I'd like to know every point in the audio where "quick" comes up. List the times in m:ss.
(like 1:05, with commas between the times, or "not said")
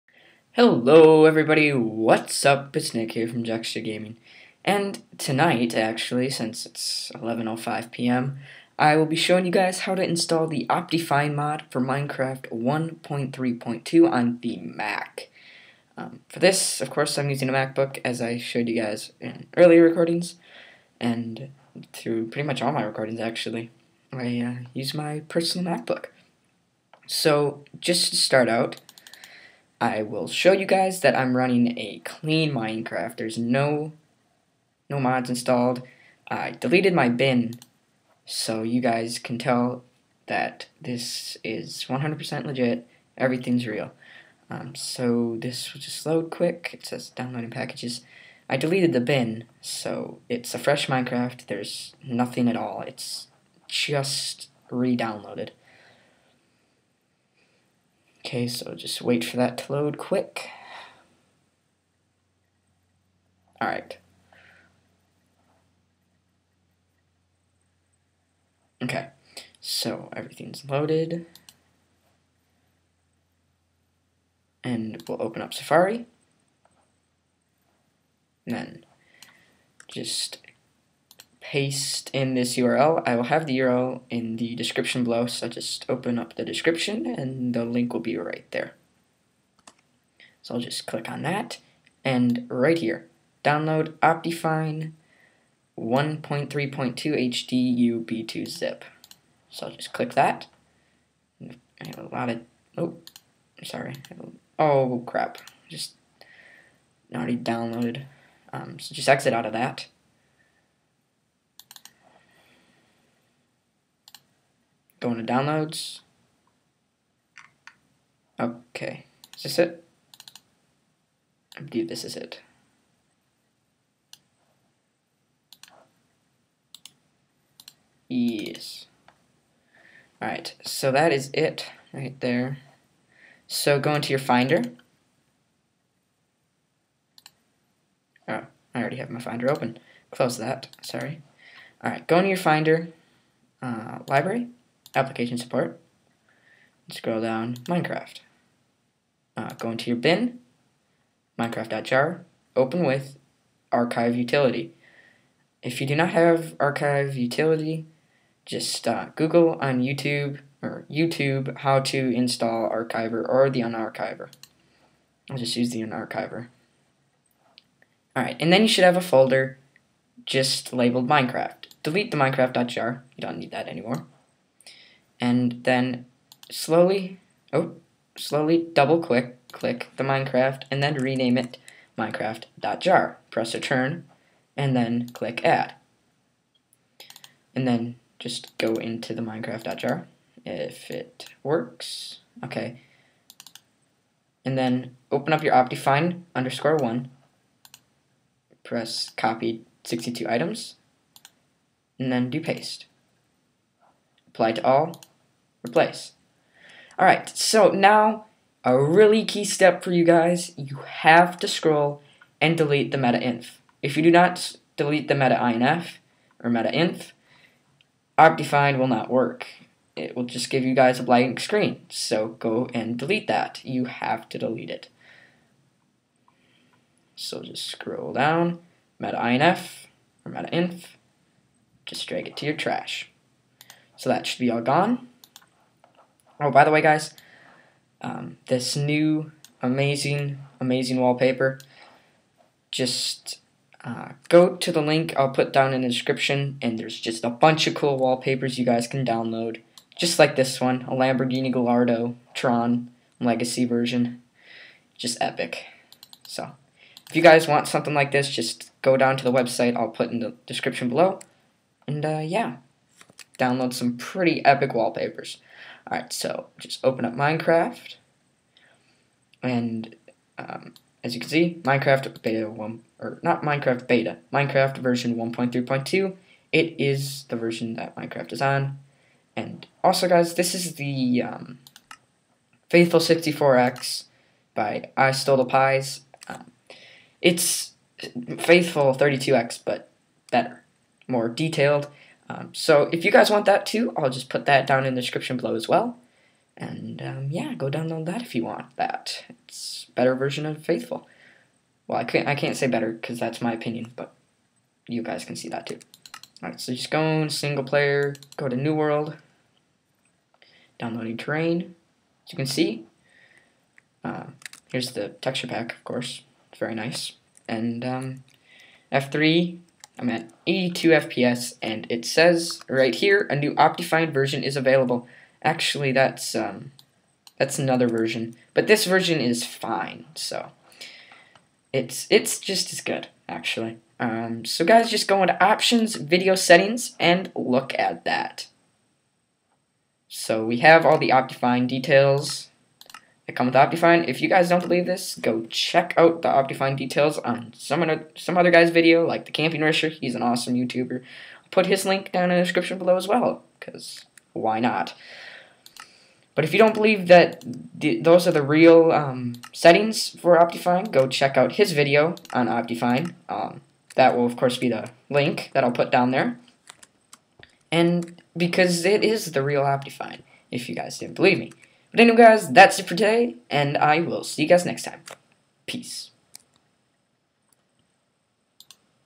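0:46, 0:59.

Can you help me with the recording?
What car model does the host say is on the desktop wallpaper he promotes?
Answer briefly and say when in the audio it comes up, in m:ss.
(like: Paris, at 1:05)
Lamborghini Gallardo, at 4:10.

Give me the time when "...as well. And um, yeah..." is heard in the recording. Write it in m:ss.
4:55.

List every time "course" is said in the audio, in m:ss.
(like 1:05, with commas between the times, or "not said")
0:16, 5:15, 6:04.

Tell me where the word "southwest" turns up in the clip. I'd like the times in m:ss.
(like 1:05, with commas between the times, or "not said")
not said.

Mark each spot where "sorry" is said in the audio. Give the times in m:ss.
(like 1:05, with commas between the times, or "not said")
1:43, 2:20.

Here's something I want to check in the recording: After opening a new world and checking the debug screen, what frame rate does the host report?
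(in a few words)
82 FPS.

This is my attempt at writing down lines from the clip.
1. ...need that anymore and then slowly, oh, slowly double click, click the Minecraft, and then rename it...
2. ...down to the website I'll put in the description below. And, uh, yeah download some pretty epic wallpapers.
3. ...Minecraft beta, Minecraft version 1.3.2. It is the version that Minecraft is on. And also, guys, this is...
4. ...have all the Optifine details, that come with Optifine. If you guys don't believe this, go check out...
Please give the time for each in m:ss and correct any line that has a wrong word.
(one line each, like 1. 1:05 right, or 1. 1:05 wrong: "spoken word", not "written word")
1. 2:53 right
2. 4:18 right
3. 4:33 right
4. 5:40 right.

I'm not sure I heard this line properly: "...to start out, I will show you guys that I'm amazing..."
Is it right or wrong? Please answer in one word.
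wrong.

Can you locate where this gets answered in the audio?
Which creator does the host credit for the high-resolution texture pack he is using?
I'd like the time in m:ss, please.
4:44.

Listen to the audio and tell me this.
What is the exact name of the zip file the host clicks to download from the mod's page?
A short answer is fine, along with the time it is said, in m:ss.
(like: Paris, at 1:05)
Optifine 1.3.2 HD UB2 zip, at 1:33.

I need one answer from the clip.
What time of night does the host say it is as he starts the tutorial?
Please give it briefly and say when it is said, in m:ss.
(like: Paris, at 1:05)
11:05pm, at 0:07.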